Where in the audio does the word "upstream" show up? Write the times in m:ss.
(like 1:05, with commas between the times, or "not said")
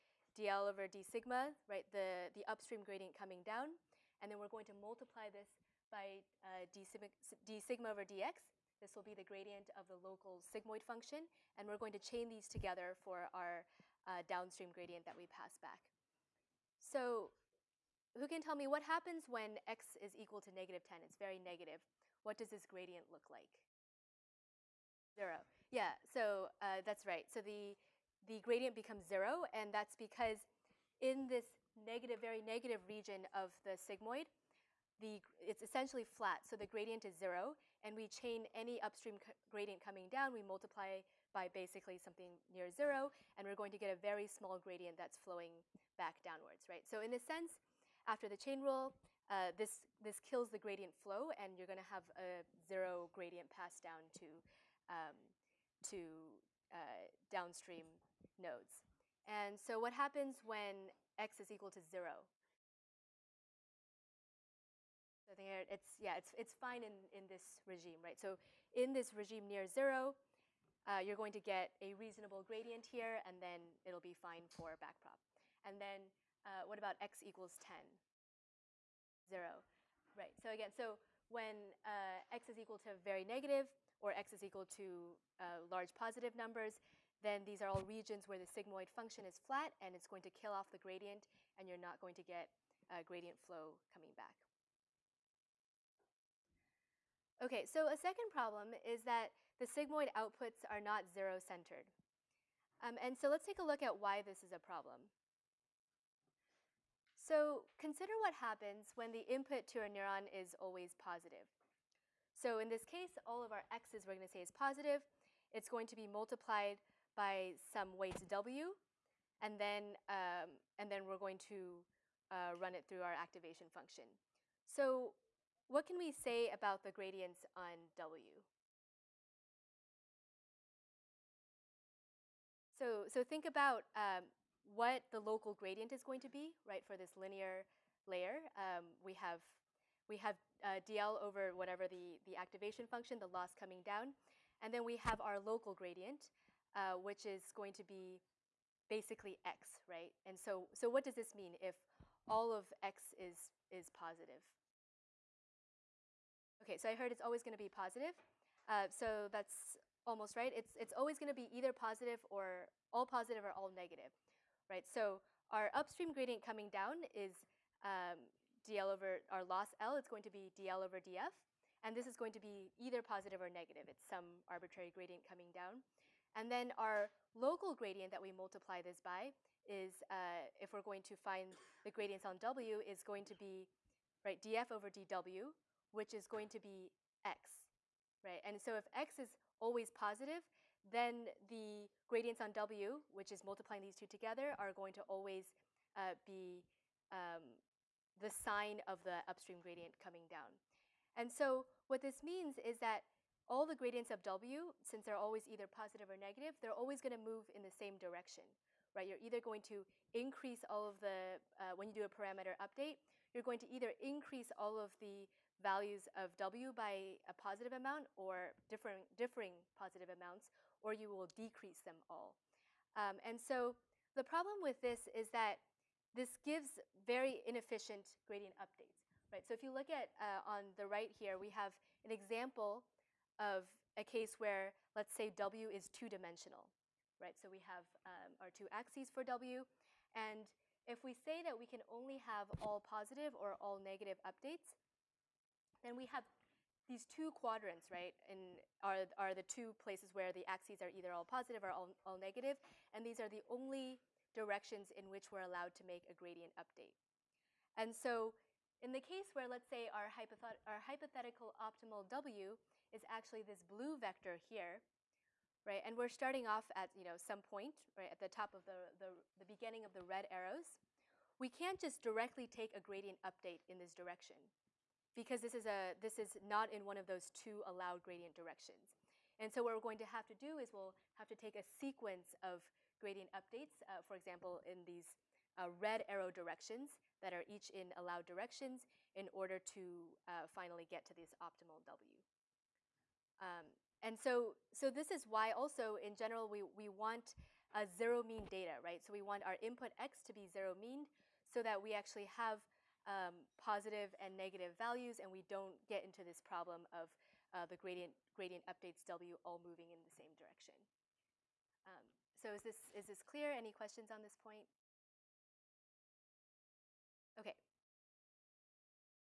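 0:02, 0:38, 2:45, 3:19.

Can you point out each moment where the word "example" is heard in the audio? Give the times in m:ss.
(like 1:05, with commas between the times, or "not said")
3:52, 4:44.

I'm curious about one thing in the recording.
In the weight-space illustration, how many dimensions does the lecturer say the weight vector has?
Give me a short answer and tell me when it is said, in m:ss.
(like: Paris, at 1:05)
2, at 3:55.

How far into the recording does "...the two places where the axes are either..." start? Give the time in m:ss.
4:09.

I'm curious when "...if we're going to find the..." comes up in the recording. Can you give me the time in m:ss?
3:00.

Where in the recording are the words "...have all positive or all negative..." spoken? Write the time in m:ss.
4:02.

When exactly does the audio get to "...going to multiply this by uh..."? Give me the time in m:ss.
0:04.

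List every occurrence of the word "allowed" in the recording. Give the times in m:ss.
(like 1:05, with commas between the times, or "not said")
4:15, 4:37, 4:47.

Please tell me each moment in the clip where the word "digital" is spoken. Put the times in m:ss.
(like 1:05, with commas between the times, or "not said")
not said.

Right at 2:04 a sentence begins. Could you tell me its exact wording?
So what can we say about the gradients on w?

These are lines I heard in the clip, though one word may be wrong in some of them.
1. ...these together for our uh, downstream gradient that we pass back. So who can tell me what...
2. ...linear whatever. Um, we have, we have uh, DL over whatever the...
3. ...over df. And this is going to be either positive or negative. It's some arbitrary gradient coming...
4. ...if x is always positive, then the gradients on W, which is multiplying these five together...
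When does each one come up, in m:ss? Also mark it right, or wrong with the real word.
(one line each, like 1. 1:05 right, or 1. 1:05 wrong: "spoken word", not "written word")
1. 0:12 right
2. 2:17 wrong: "layer", not "whatever"
3. 2:50 right
4. 3:08 wrong: "two", not "five".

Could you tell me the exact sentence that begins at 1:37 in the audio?
Okay, so a second problem is that the sigmoid outputs are not zero-centered.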